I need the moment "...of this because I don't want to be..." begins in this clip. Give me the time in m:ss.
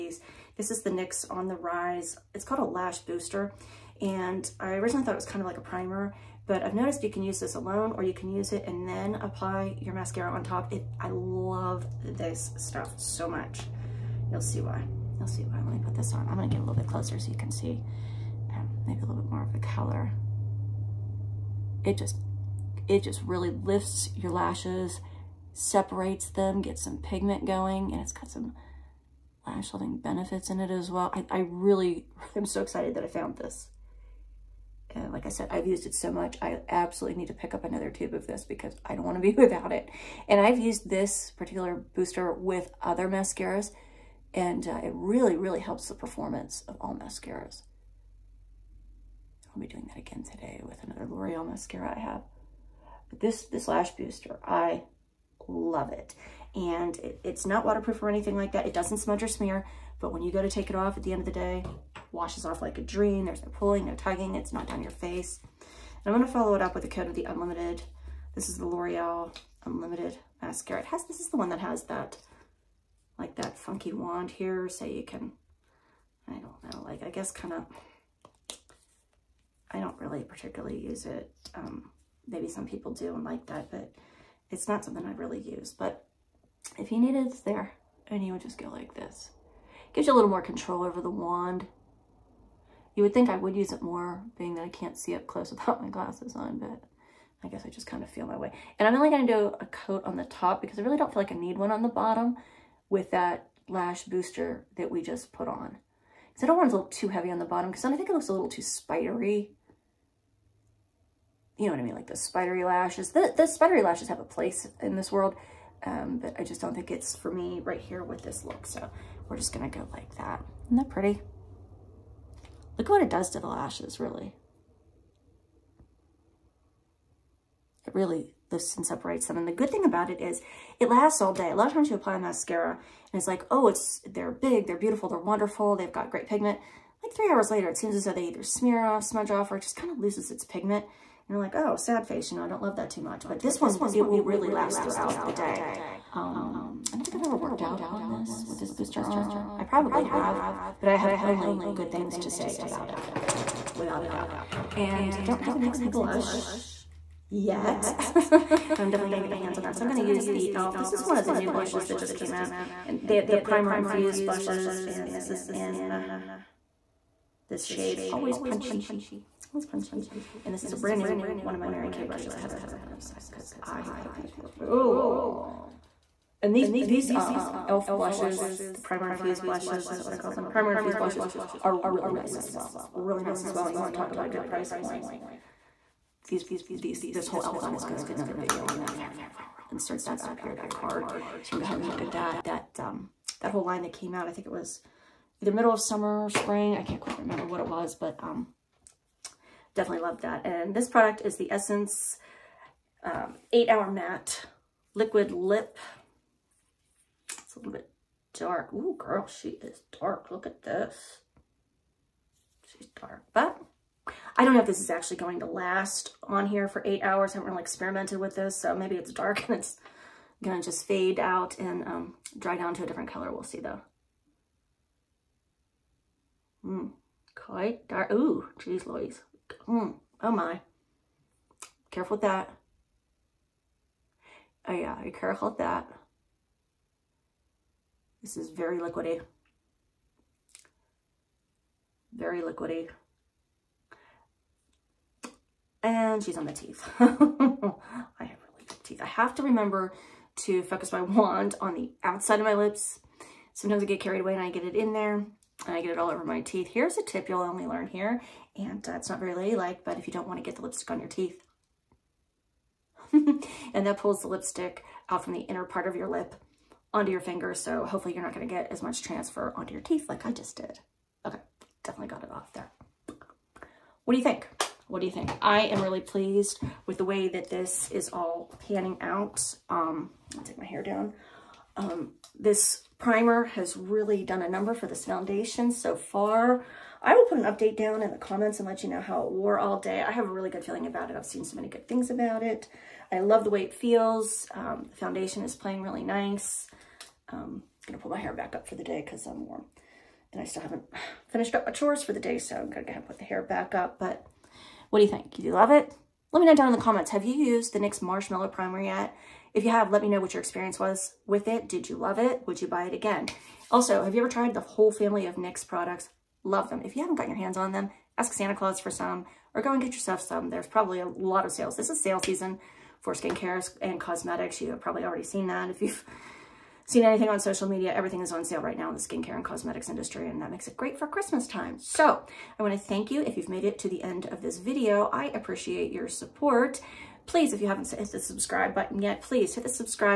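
0:38.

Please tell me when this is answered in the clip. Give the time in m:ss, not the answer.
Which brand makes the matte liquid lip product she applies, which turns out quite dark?
3:21.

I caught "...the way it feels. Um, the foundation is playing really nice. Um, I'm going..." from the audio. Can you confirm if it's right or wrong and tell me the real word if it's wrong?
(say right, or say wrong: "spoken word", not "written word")
right.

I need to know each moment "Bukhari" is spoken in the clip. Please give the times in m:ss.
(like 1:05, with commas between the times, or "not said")
not said.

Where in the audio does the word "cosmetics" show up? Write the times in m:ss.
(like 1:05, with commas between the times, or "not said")
5:23, 5:29.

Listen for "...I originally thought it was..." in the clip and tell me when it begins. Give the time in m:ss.
0:04.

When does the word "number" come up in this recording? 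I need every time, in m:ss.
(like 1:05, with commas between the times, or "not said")
4:44.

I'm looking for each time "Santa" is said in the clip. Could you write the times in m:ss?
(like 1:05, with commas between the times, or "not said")
5:18.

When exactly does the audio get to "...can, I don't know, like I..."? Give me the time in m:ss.
1:15.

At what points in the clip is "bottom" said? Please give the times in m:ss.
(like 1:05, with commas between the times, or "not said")
1:41, 1:47.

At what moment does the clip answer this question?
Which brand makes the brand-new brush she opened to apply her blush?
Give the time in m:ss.
2:51.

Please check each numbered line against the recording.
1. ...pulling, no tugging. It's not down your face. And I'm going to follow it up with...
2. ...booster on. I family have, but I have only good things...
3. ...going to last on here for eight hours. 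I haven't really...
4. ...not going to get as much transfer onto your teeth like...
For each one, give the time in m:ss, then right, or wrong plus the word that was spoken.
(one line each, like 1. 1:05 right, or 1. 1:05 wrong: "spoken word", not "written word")
1. 1:03 right
2. 2:28 wrong: "probably", not "family"
3. 3:35 right
4. 4:28 right.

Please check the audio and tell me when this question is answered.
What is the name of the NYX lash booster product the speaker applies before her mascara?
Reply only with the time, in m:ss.
0:01.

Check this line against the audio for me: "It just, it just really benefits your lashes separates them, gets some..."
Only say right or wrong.
wrong.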